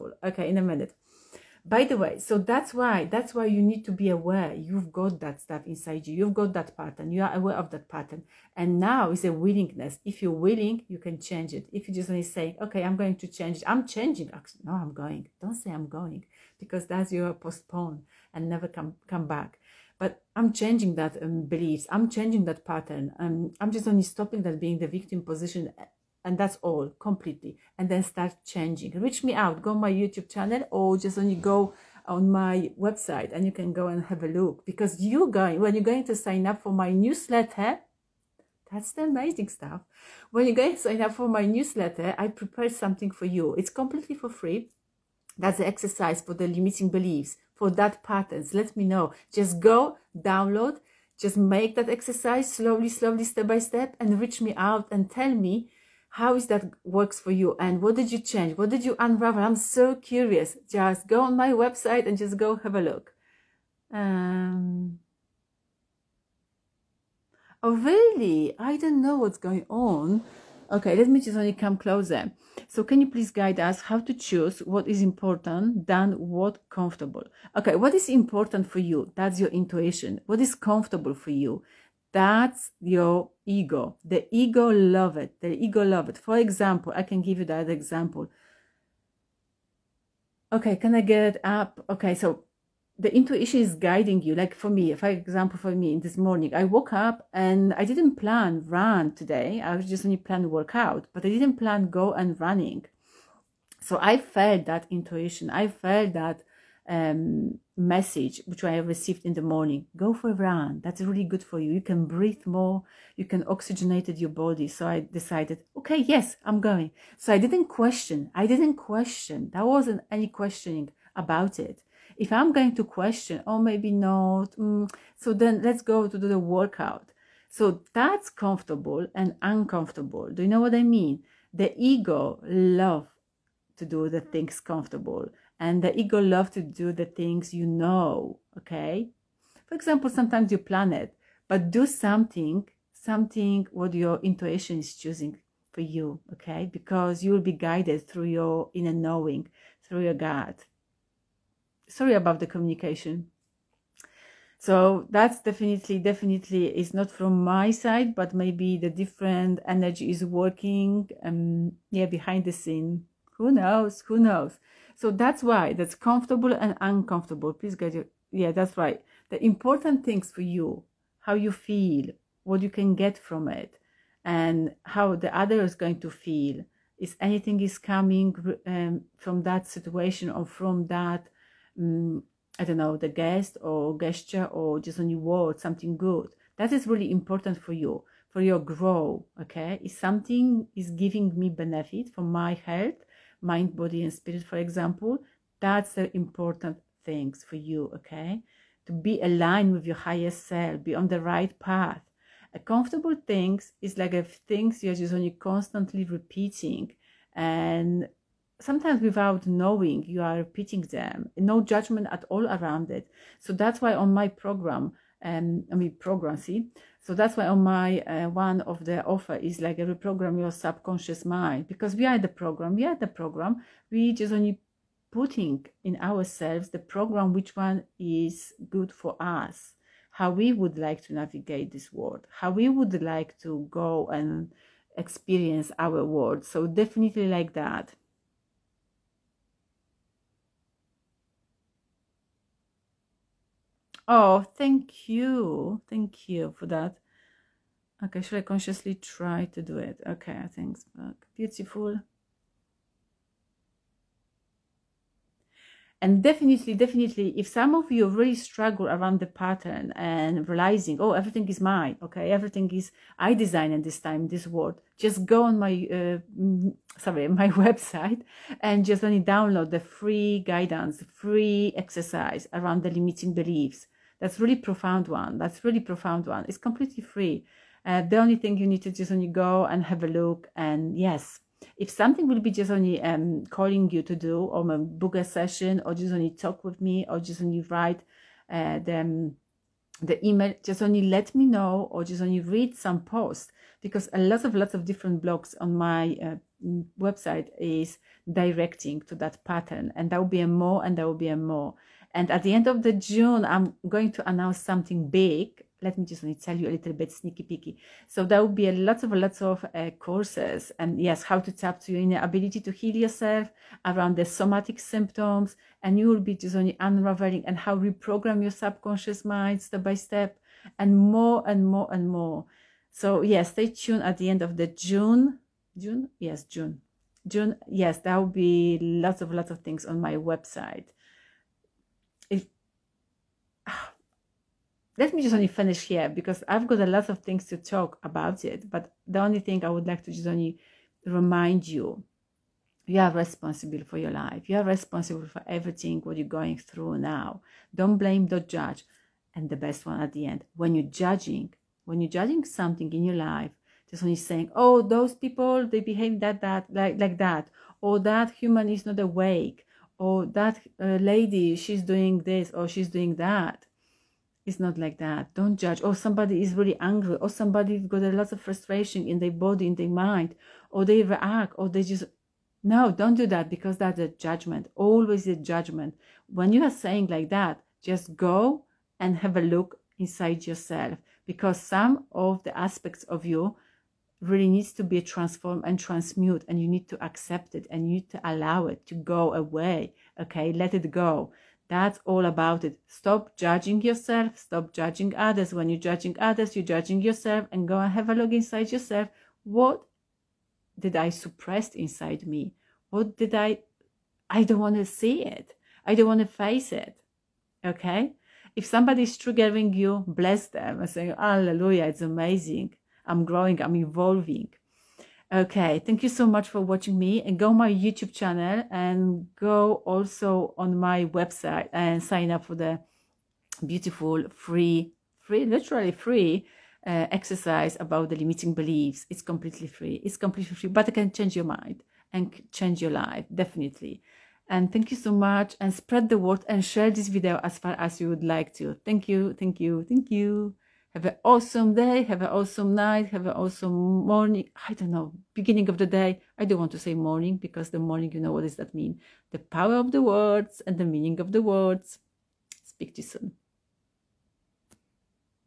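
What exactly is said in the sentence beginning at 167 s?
Please get your, yeah, that's right.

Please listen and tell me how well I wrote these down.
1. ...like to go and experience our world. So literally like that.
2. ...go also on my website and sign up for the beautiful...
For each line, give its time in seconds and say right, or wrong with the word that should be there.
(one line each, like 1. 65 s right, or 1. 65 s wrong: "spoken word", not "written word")
1. 233 s wrong: "definitely", not "literally"
2. 419 s right.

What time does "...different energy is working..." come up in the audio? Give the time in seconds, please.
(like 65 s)
158 s.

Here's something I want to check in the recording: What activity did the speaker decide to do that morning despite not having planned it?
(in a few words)
running.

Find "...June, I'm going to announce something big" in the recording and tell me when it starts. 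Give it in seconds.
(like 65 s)
302 s.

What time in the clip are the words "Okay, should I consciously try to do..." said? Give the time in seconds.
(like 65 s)
248 s.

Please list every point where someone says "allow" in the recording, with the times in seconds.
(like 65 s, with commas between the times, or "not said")
388 s.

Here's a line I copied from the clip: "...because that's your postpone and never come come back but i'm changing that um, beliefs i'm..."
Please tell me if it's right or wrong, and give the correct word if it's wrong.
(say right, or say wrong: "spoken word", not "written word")
right.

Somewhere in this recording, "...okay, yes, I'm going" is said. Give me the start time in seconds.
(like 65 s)
115 s.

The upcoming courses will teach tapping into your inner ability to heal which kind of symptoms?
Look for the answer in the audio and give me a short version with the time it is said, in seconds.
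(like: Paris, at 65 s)
somatic symptoms, at 314 s.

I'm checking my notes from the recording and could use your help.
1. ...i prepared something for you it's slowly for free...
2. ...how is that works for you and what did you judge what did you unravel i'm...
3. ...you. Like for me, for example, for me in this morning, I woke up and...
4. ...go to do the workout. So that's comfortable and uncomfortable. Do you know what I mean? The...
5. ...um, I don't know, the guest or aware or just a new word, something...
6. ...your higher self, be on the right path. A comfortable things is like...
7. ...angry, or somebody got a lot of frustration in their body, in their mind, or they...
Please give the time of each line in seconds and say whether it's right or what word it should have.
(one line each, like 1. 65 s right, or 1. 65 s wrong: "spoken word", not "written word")
1. 42 s wrong: "completely", not "slowly"
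2. 56 s wrong: "change", not "judge"
3. 94 s right
4. 125 s right
5. 181 s wrong: "gesture", not "aware"
6. 199 s right
7. 366 s right.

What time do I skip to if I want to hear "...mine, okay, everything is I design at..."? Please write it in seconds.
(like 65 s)
261 s.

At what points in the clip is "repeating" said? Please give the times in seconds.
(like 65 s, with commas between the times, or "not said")
206 s, 210 s.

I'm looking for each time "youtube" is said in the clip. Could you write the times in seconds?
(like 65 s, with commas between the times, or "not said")
29 s, 417 s.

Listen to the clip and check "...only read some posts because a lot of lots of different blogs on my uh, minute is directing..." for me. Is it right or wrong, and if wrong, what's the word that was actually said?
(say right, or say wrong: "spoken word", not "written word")
wrong: "website", not "minute".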